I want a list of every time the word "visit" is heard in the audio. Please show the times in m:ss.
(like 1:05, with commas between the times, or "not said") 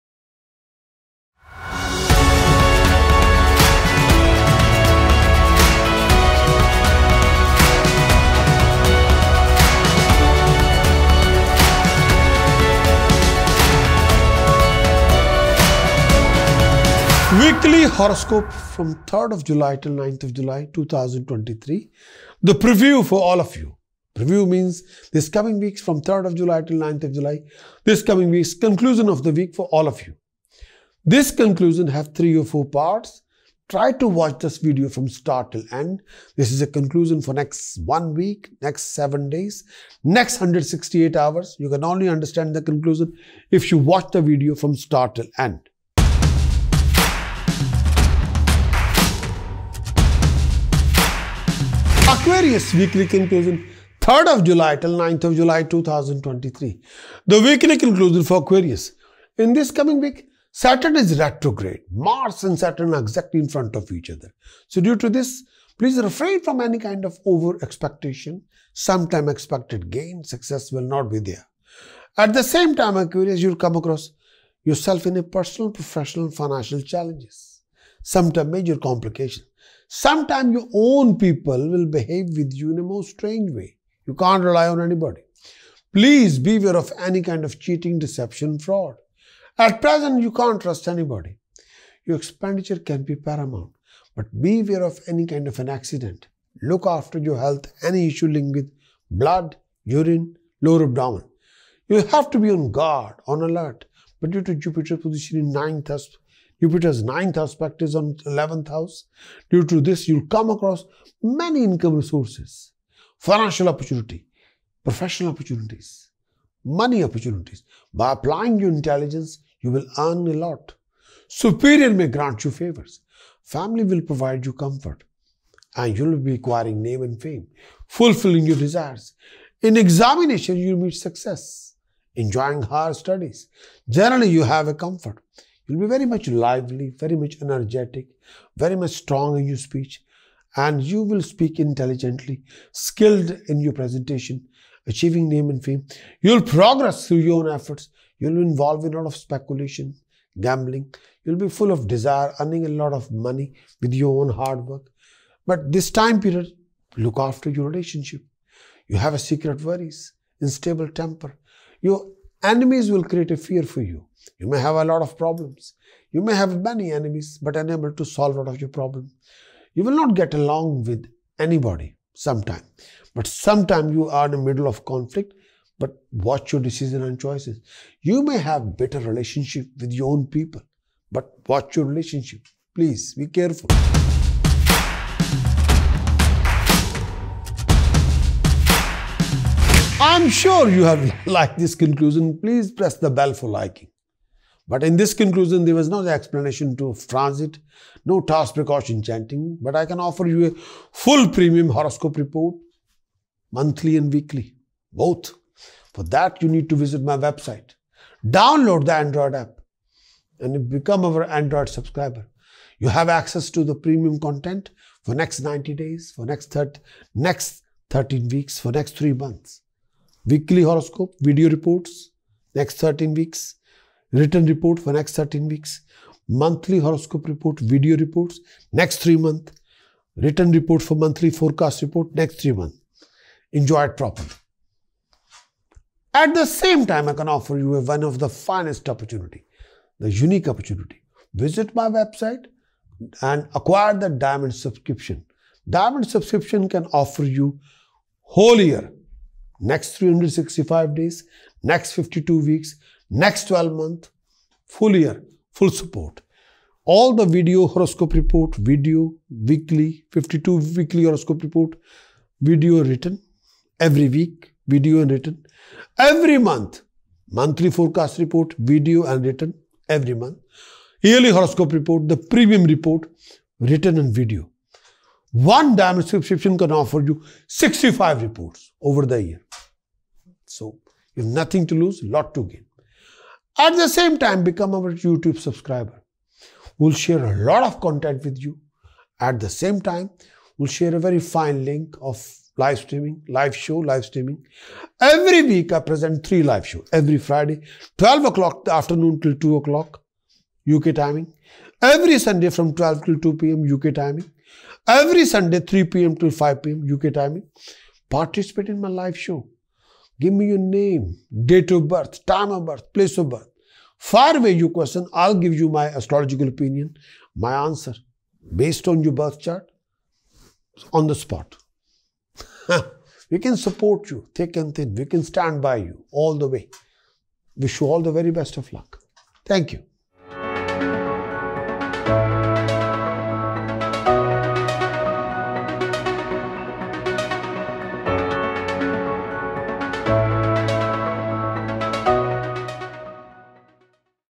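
3:26, 4:01.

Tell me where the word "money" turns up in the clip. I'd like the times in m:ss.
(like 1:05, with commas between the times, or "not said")
1:56, 2:33.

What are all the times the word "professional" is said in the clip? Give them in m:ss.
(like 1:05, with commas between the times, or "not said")
1:15, 1:54.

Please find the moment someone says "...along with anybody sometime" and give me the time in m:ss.
2:50.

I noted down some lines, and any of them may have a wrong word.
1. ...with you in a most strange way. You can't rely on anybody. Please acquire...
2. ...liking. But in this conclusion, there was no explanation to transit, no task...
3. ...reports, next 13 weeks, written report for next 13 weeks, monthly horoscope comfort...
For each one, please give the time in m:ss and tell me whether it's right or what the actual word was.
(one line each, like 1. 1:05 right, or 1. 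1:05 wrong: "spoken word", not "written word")
1. 1:22 wrong: "beware", not "acquire"
2. 3:13 right
3. 3:41 wrong: "report", not "comfort".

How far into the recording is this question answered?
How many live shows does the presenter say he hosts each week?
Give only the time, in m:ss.
4:56.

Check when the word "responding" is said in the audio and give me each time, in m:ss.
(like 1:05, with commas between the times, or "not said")
not said.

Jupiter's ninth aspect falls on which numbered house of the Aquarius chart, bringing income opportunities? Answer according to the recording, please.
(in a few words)
11th house.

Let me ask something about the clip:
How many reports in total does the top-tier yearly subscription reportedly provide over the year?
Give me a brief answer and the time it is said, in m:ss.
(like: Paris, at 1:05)
65, at 4:37.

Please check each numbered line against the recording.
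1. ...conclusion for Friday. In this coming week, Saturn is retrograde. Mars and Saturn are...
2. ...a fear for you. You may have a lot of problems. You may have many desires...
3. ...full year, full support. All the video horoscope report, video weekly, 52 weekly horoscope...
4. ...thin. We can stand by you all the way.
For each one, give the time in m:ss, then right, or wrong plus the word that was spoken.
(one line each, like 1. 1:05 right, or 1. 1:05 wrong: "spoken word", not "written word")
1. 0:57 wrong: "Aquarius", not "Friday"
2. 2:43 wrong: "enemies", not "desires"
3. 4:14 right
4. 5:24 right.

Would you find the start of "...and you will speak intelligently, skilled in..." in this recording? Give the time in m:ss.
2:20.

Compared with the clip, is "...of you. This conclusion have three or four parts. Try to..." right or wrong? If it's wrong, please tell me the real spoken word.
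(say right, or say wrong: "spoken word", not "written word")
right.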